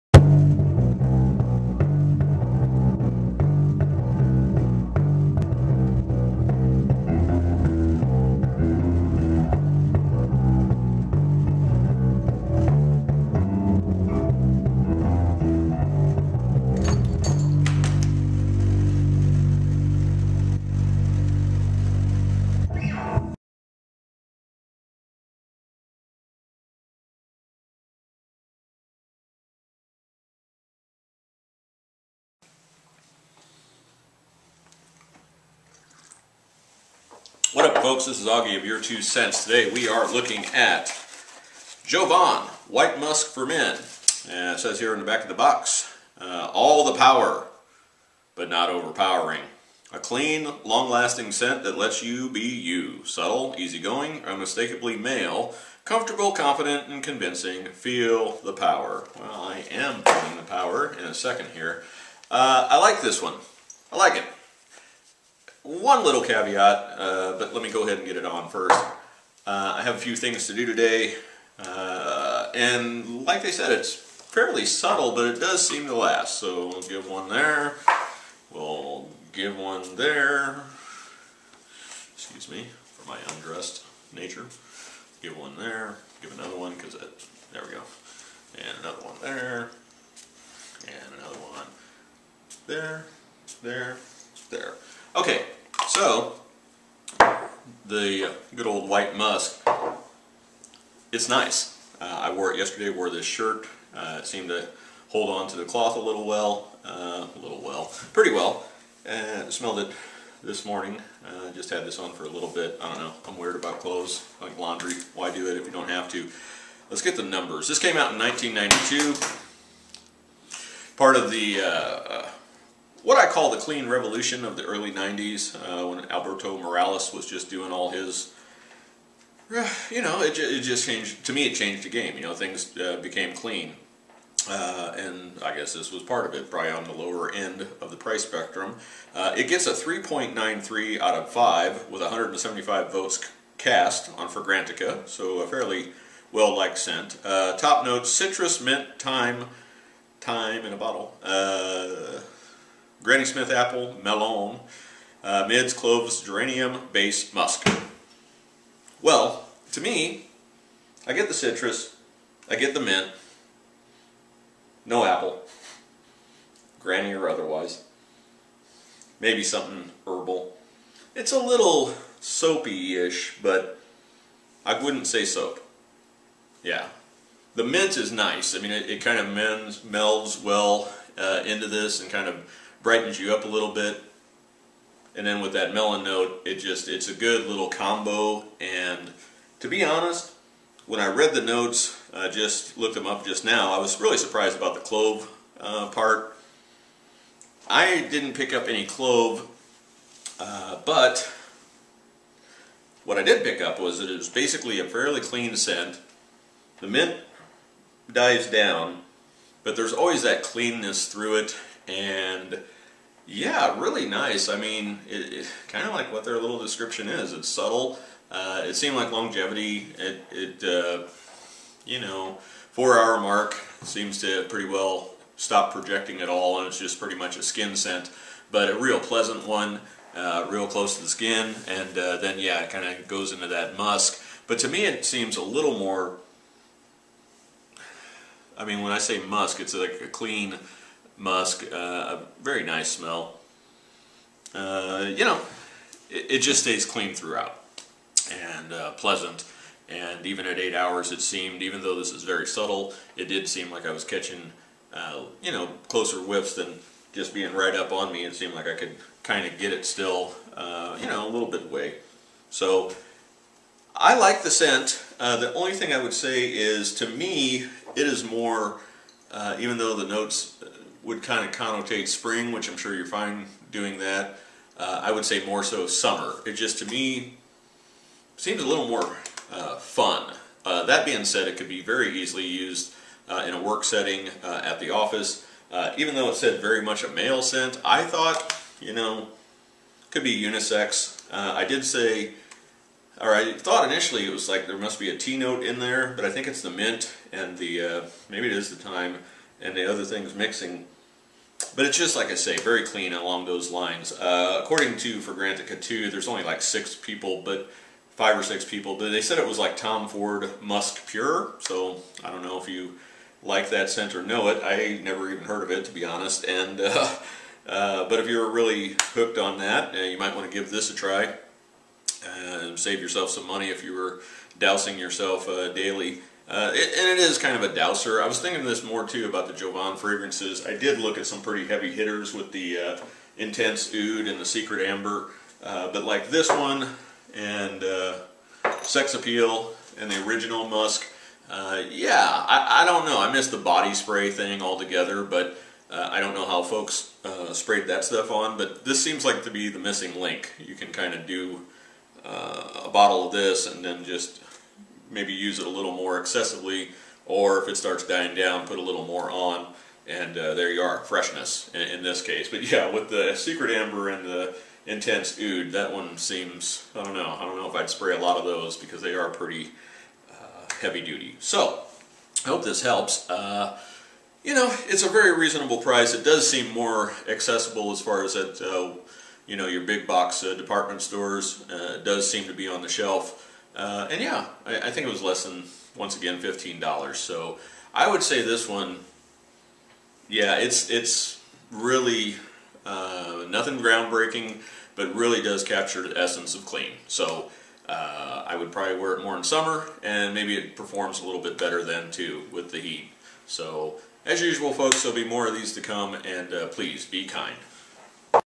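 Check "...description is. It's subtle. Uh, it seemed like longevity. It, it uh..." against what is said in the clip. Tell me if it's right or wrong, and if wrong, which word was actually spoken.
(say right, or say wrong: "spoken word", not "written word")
right.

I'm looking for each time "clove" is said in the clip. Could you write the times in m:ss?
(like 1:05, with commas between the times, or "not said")
2:35, 3:14, 3:18.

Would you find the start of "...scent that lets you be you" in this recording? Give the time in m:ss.
0:51.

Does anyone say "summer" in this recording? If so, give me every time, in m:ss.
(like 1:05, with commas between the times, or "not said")
4:35, 6:39.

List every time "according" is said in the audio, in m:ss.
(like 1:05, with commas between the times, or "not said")
5:04.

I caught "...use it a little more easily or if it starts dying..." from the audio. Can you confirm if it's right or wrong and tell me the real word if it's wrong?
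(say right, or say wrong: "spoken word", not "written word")
wrong: "excessively", not "easily".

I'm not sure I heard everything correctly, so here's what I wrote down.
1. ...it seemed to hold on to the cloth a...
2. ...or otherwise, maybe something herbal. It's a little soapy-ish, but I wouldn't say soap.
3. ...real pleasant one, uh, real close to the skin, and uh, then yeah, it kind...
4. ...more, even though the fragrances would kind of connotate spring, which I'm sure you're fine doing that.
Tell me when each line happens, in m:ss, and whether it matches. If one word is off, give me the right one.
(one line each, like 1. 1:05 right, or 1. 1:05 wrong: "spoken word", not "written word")
1. 1:44 right
2. 2:47 right
3. 3:48 right
4. 4:28 wrong: "notes", not "fragrances".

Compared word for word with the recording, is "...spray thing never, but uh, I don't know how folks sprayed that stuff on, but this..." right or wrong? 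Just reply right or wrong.
wrong.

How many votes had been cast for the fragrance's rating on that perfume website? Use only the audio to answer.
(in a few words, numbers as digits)
175.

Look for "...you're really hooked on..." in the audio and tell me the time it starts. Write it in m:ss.
5:18.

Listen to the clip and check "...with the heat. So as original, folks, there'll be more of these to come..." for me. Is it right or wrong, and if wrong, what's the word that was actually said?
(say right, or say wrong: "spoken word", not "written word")
wrong: "usual", not "original".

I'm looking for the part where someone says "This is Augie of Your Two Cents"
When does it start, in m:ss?
0:38.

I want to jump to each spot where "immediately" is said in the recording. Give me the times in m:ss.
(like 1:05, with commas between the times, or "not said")
not said.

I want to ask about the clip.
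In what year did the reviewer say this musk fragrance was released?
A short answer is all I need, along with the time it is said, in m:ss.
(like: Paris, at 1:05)
1992, at 1:58.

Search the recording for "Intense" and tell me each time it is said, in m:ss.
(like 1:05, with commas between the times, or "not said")
5:33, 6:04.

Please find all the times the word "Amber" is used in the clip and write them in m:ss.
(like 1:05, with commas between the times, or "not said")
5:34, 6:03.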